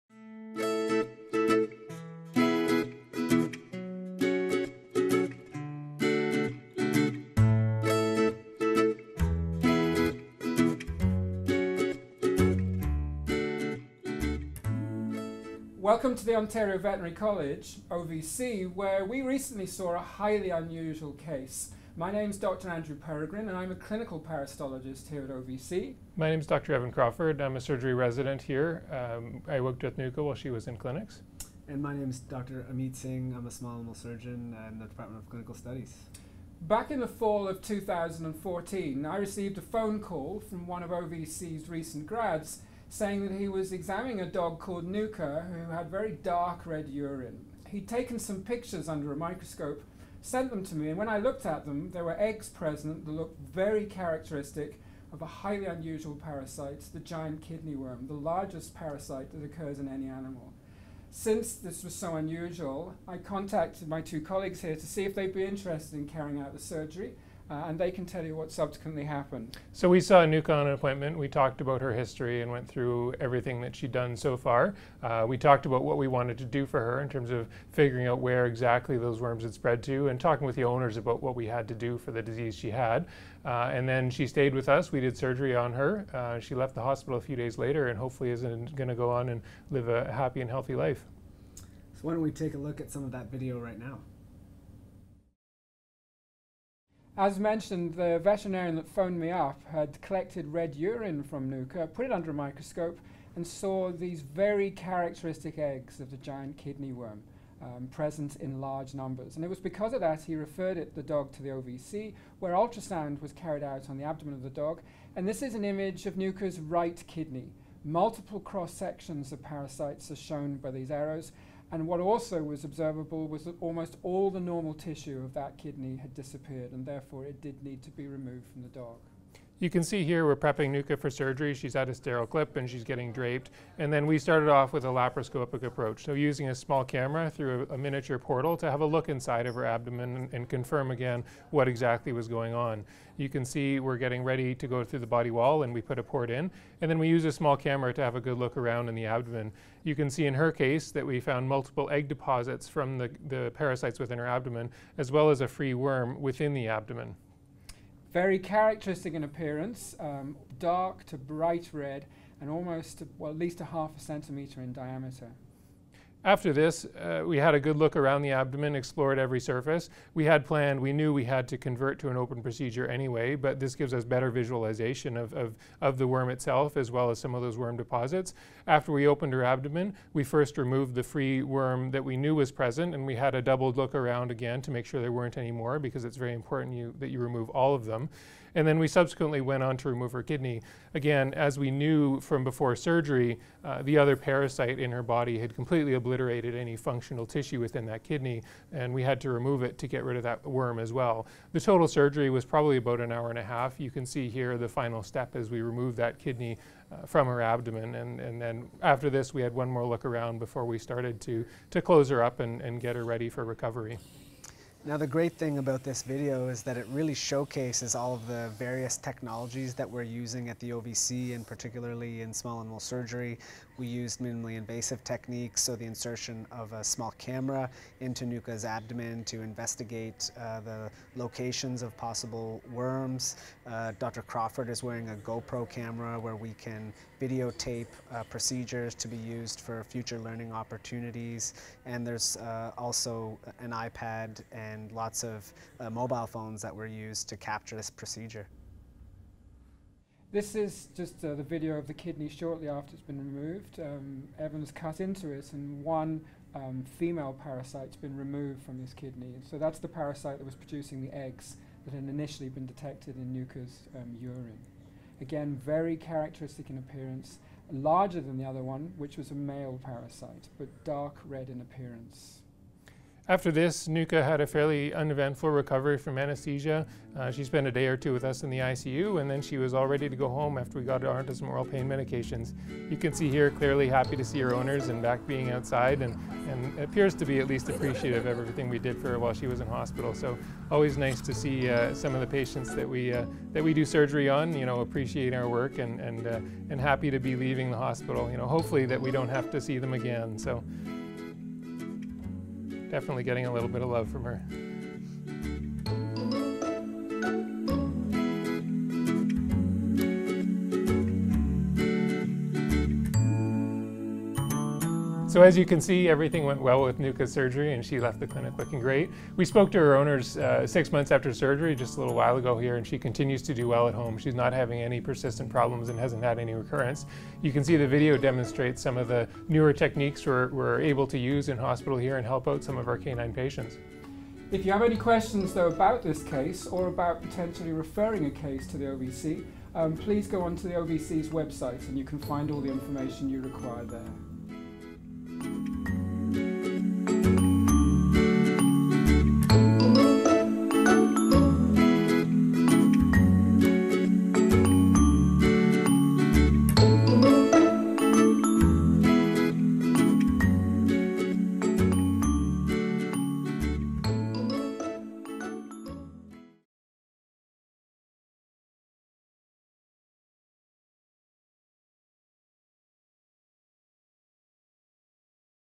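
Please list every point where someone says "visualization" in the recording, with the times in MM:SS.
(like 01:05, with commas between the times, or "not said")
02:54.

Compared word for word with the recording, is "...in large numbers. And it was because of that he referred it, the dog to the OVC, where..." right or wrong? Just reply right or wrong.
right.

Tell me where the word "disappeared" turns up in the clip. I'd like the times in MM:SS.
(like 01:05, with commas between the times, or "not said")
02:06.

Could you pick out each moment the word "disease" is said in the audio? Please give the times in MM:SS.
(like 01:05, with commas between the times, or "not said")
01:22.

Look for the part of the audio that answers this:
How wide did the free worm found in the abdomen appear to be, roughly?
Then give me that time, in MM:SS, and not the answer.
02:43.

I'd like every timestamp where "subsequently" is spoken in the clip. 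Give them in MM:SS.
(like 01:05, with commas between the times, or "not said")
01:08, 03:08.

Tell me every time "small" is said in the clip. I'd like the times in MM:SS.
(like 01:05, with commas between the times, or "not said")
00:33, 02:16, 02:27, 03:42, 03:46.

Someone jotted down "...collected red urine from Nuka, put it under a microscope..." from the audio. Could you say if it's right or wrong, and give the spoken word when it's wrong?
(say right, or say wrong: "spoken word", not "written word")
right.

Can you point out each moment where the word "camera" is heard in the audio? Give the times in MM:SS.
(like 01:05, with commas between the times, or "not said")
02:16, 02:27, 03:47, 03:55.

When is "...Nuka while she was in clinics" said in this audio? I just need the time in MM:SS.
00:29.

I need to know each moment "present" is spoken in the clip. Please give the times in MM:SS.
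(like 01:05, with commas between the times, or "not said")
00:52, 01:47, 03:02.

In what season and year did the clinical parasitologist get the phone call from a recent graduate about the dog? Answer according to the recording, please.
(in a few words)
fall of 2014.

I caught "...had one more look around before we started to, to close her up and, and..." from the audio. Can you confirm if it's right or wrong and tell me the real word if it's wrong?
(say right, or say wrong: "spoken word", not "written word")
right.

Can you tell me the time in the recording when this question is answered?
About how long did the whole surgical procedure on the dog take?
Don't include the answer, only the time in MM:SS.
03:22.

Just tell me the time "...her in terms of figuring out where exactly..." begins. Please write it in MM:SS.
01:16.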